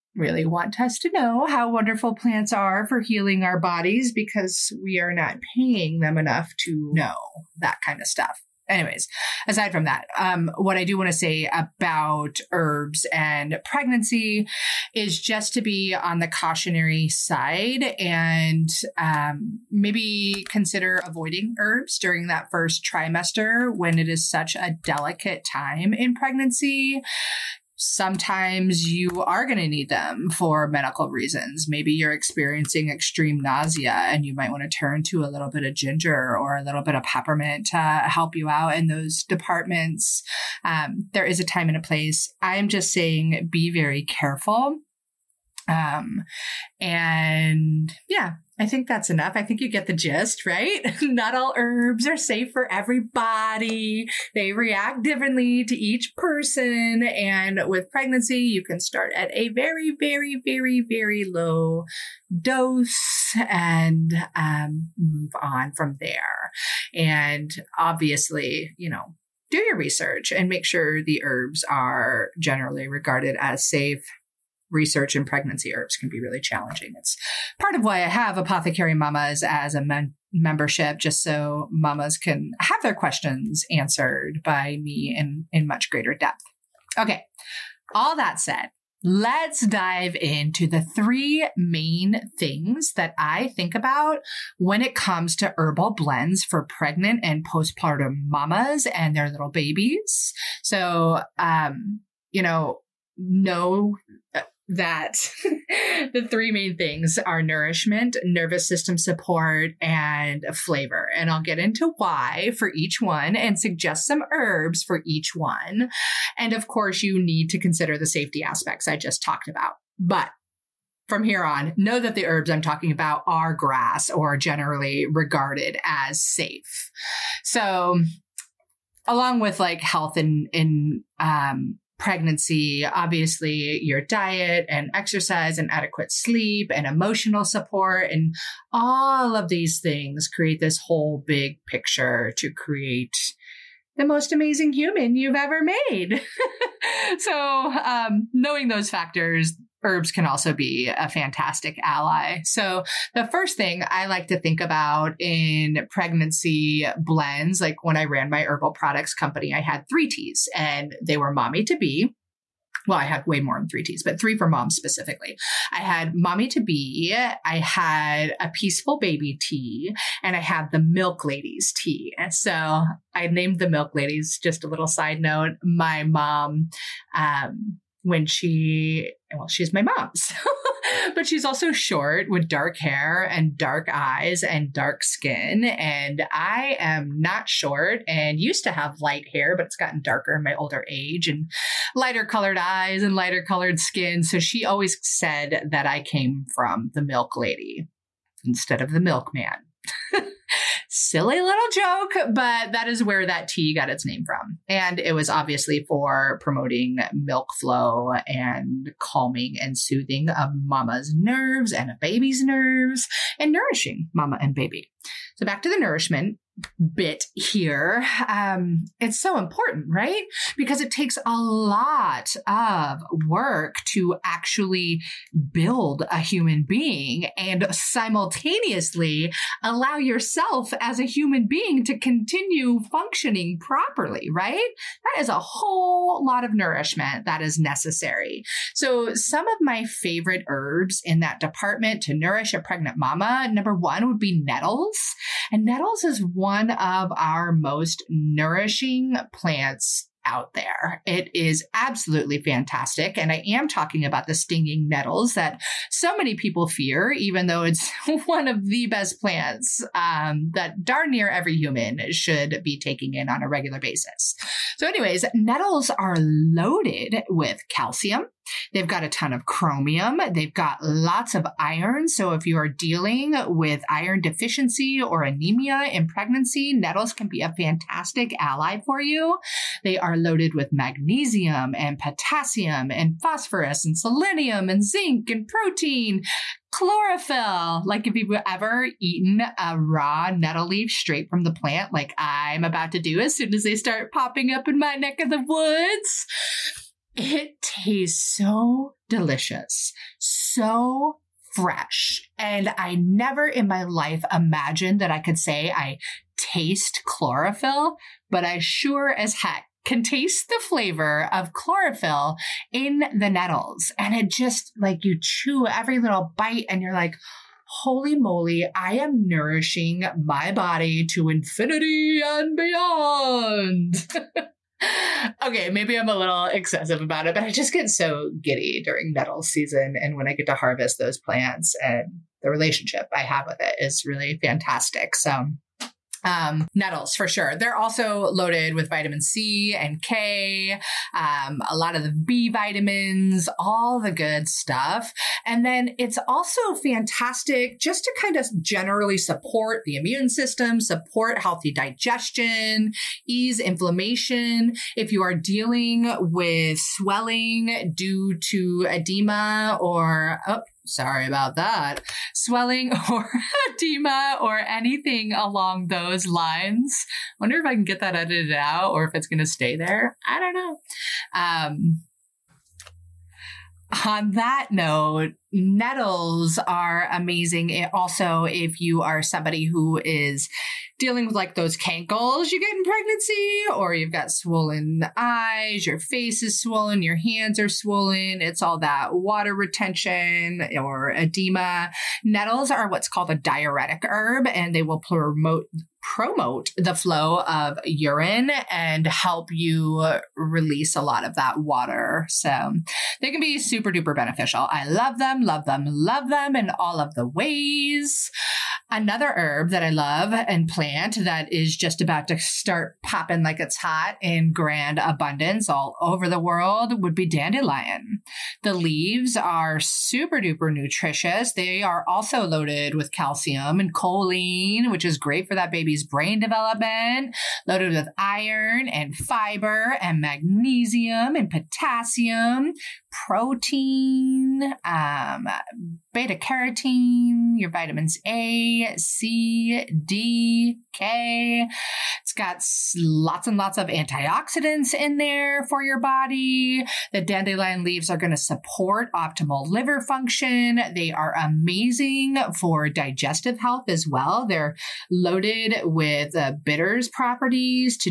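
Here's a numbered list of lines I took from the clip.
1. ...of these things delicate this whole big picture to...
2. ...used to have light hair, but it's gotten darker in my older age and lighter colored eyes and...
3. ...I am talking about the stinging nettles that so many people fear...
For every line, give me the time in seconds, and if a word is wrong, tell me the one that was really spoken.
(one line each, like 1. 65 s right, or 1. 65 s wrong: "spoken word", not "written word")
1. 139 s wrong: "create", not "delicate"
2. 188 s right
3. 253 s right.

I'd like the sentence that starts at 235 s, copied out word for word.
That is a whole lot of nourishment that is necessary.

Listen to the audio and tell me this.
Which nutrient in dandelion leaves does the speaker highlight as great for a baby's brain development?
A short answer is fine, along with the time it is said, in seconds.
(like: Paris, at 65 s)
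Choline, at 423 s.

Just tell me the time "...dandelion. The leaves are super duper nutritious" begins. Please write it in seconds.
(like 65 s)
417 s.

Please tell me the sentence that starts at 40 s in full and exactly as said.
Um, there is a time and a place.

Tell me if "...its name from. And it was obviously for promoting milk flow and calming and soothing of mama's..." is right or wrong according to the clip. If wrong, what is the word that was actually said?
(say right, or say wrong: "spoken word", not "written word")
right.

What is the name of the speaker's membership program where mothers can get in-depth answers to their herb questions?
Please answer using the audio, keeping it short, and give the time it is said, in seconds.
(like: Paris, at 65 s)
Apothecary Mamas, at 78 s.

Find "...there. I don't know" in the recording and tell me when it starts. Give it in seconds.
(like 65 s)
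369 s.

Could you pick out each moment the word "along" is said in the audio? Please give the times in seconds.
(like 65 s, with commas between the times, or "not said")
129 s, 365 s.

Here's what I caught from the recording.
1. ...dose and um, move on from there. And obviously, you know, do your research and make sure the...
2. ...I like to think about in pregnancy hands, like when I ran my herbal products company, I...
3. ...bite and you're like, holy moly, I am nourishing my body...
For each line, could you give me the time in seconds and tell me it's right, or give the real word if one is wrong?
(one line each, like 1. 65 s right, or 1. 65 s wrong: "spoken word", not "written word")
1. 62 s right
2. 153 s wrong: "blends", not "hands"
3. 316 s right.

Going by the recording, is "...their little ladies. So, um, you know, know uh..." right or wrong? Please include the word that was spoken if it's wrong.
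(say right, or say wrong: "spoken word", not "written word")
wrong: "babies", not "ladies".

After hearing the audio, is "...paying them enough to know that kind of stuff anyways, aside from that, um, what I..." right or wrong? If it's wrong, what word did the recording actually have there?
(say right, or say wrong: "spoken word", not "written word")
right.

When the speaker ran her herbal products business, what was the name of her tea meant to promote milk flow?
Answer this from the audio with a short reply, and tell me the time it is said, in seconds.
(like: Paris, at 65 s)
Milk Ladies Tea, at 170 s.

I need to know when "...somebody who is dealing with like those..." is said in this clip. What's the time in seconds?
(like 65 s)
379 s.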